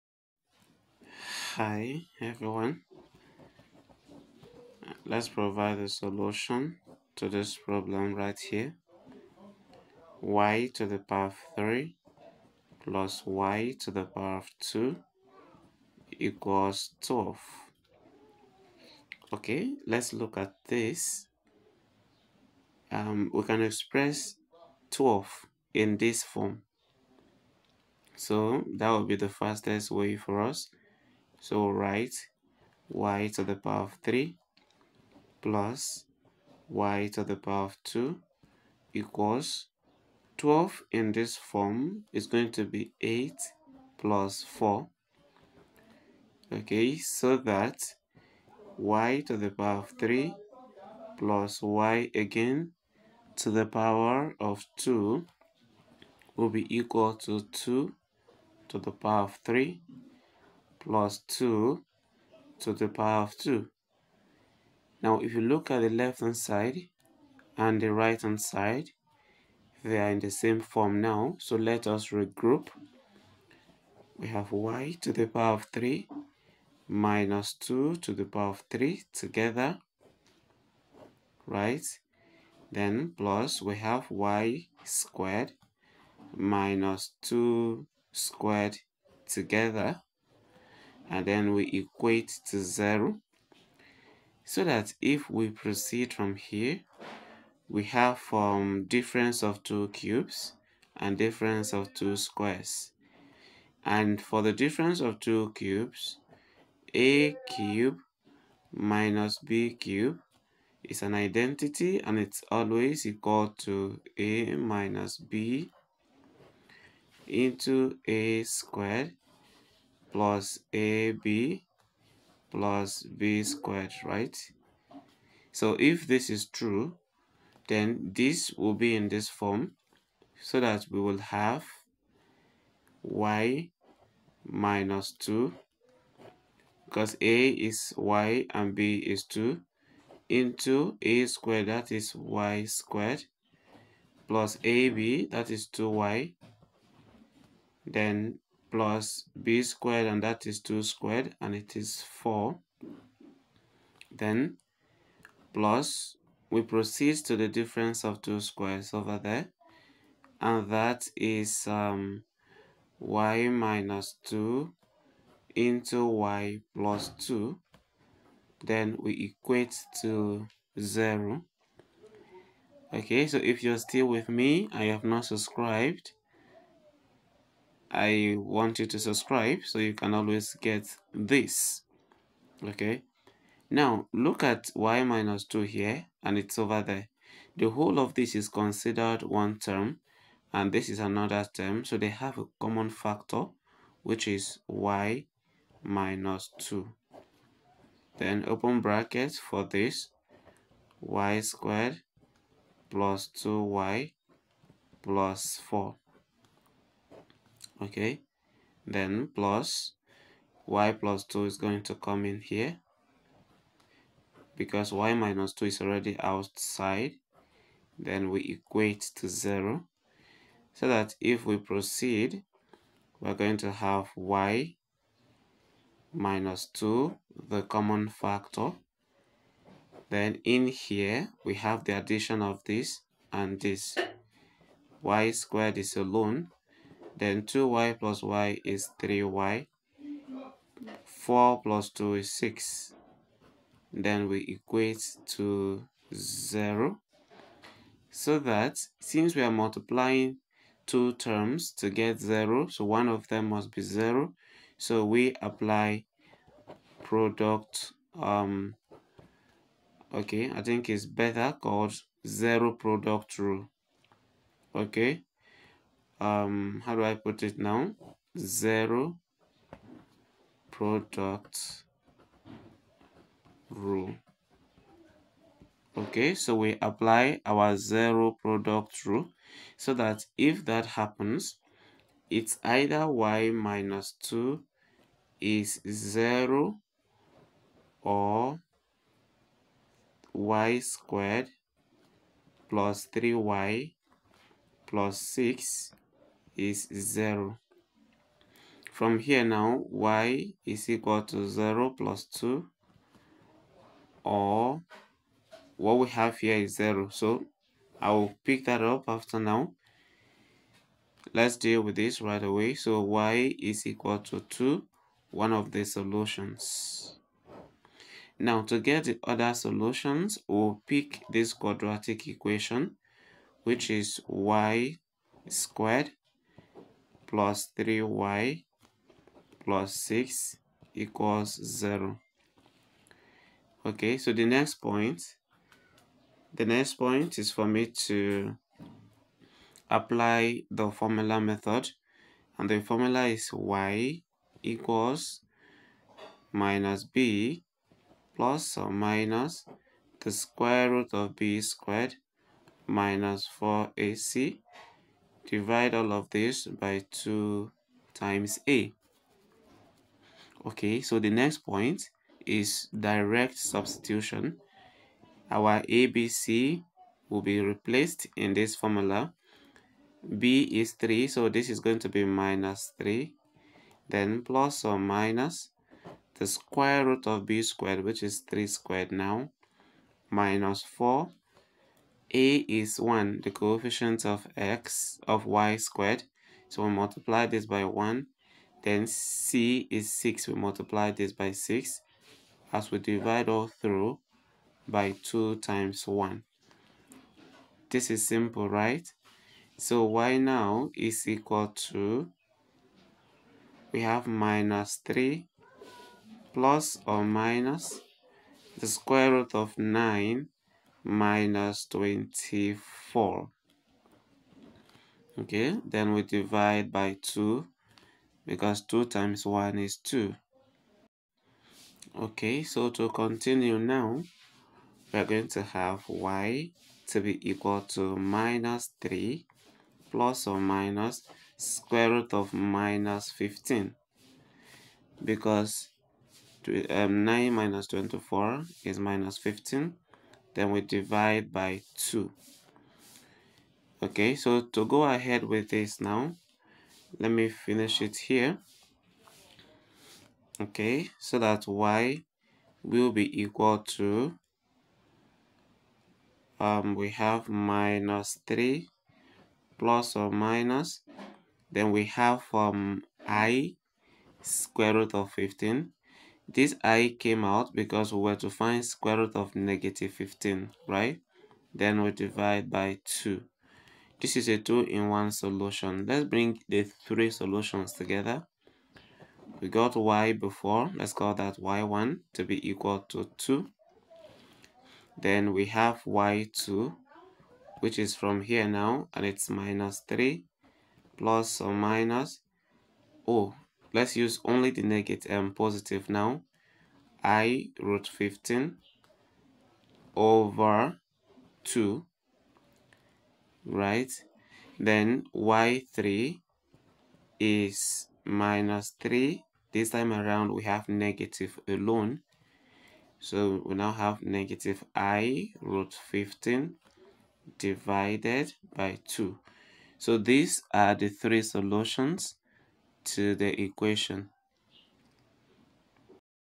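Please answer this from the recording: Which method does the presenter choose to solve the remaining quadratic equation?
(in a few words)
formula method.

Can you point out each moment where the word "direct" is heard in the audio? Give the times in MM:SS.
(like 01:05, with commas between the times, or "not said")
06:02.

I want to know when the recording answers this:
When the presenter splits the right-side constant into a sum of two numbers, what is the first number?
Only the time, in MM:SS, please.
00:43.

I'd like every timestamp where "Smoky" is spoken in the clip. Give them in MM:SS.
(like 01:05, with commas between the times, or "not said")
not said.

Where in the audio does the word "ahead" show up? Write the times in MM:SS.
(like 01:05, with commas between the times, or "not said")
07:25.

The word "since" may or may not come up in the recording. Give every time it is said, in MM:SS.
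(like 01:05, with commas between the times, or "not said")
04:08.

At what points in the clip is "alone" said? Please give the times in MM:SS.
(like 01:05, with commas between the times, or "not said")
03:55, 08:31.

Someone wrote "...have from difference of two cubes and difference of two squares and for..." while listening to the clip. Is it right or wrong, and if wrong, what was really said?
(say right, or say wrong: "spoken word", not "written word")
right.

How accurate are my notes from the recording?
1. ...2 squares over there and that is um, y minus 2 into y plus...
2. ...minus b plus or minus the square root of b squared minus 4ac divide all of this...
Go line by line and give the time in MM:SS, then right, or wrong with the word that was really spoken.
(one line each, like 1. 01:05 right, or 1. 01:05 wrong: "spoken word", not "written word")
1. 02:38 right
2. 05:46 right.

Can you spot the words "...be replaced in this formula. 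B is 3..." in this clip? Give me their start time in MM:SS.
06:07.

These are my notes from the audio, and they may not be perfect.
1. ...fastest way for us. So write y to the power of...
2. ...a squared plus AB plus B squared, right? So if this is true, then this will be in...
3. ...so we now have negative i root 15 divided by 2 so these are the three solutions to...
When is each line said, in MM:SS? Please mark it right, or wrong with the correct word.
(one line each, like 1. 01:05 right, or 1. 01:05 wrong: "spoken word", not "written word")
1. 00:29 right
2. 01:58 right
3. 08:33 right.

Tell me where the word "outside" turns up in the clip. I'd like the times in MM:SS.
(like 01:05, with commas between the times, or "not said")
03:36.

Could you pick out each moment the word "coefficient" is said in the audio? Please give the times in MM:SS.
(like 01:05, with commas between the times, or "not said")
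06:23.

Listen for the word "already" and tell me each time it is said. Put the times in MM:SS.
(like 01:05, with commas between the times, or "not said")
03:35.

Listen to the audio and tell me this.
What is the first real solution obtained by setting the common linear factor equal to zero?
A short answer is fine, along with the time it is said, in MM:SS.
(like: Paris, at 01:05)
2, at 05:13.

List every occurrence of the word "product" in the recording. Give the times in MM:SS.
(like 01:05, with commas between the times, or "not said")
04:17, 04:22, 04:30, 04:38.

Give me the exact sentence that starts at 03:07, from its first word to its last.
The whole of this is considered one term and this is another term.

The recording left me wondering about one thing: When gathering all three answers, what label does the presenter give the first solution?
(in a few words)
y1.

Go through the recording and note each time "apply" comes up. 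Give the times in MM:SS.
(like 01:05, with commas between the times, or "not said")
04:15, 04:36, 05:39.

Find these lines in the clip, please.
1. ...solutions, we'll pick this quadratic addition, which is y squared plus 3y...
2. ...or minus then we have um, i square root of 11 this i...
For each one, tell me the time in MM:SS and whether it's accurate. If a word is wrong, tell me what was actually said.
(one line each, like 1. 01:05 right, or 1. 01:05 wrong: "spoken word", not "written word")
1. 05:19 wrong: "equation", not "addition"
2. 07:40 wrong: "15", not "11".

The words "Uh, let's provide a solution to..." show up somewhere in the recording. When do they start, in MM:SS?
00:04.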